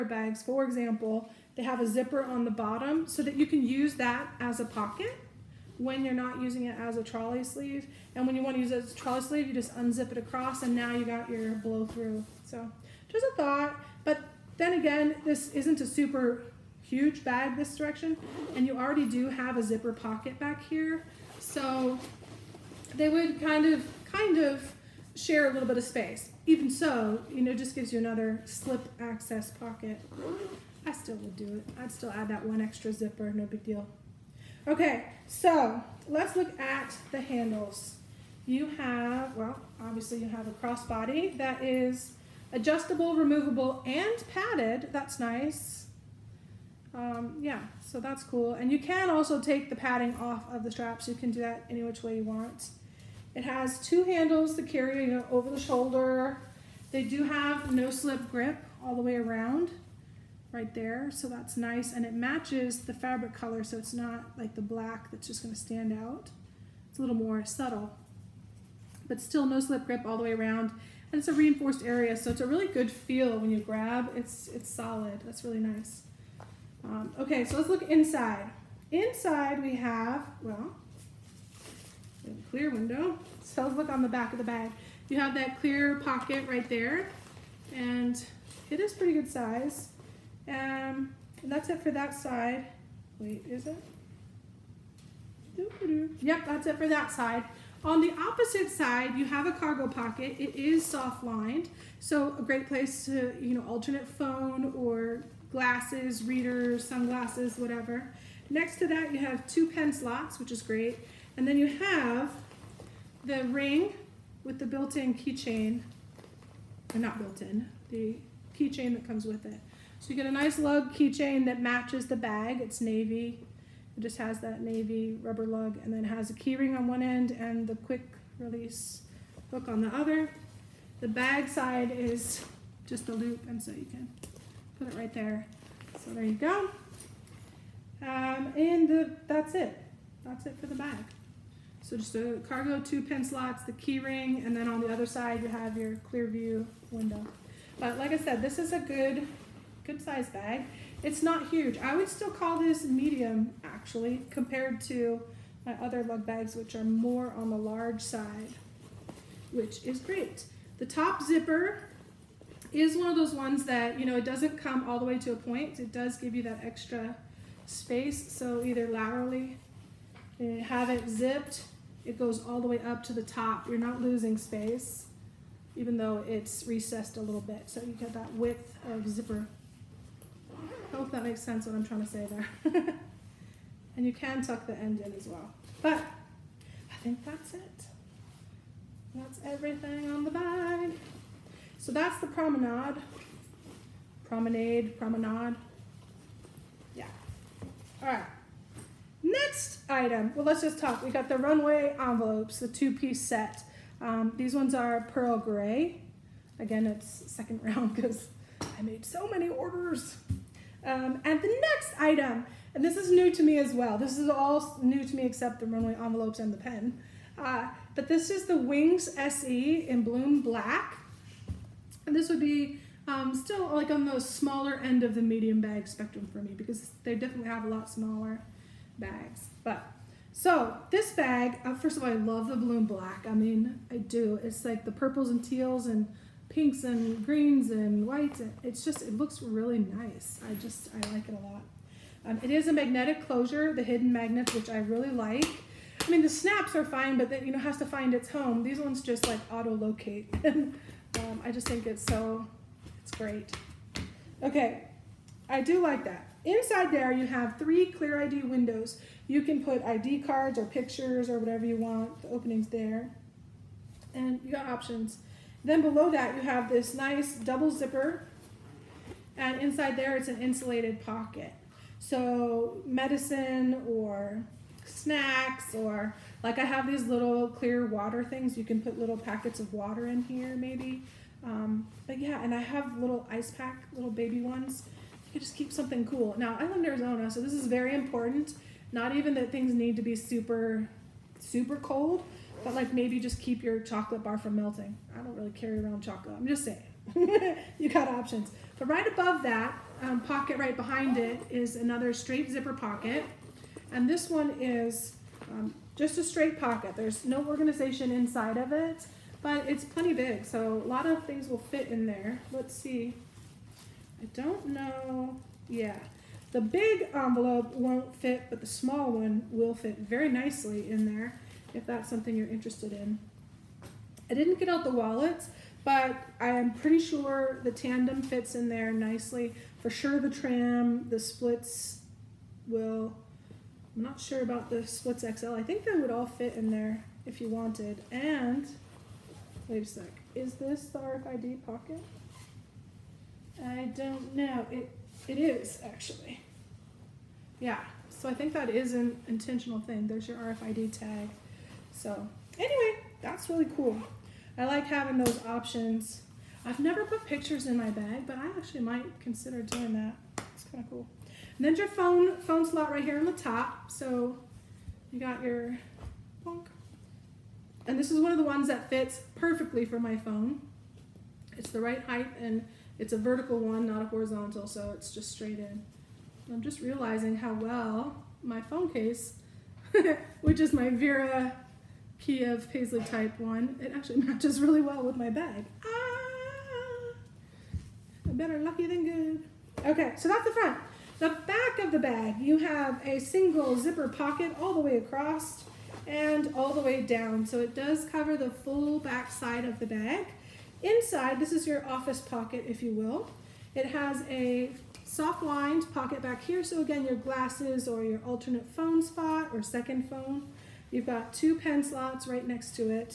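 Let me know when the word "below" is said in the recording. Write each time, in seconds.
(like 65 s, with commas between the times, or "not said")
265 s.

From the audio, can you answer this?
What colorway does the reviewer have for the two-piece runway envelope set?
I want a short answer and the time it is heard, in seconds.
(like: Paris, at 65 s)
Pearl gray, at 205 s.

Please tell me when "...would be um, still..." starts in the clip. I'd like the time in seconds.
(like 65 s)
222 s.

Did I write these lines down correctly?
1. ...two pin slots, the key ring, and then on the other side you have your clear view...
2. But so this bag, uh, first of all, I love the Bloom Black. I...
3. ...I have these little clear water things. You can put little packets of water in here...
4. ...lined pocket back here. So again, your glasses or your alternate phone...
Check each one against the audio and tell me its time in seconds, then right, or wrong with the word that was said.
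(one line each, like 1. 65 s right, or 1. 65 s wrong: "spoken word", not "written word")
1. 142 s right
2. 229 s right
3. 276 s right
4. 405 s right.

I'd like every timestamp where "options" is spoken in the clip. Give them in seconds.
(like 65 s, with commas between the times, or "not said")
264 s, 298 s, 355 s.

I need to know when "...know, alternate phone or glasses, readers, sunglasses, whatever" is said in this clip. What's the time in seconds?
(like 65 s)
103 s.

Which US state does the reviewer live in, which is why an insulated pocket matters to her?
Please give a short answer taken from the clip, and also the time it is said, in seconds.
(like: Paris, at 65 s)
Arizona, at 286 s.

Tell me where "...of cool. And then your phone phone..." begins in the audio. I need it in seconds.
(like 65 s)
360 s.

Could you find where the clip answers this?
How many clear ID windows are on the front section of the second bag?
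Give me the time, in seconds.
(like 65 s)
257 s.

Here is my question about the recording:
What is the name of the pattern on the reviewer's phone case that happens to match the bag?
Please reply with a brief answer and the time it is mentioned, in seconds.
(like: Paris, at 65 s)
Paisley, at 382 s.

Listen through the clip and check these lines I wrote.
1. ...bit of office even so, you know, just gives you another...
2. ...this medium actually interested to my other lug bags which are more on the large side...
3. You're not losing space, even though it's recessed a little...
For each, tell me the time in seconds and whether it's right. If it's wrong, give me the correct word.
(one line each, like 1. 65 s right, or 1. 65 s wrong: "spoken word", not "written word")
1. 25 s wrong: "space", not "office"
2. 152 s wrong: "compared", not "interested"
3. 173 s right.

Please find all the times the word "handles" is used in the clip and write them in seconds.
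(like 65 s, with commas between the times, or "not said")
37 s, 54 s.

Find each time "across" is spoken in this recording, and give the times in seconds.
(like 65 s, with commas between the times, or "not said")
10 s, 394 s.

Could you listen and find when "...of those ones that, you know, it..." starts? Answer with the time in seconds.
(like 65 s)
163 s.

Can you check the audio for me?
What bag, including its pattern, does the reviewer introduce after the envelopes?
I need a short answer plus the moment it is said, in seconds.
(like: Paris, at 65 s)
Wings SE in Bloom Black, at 218 s.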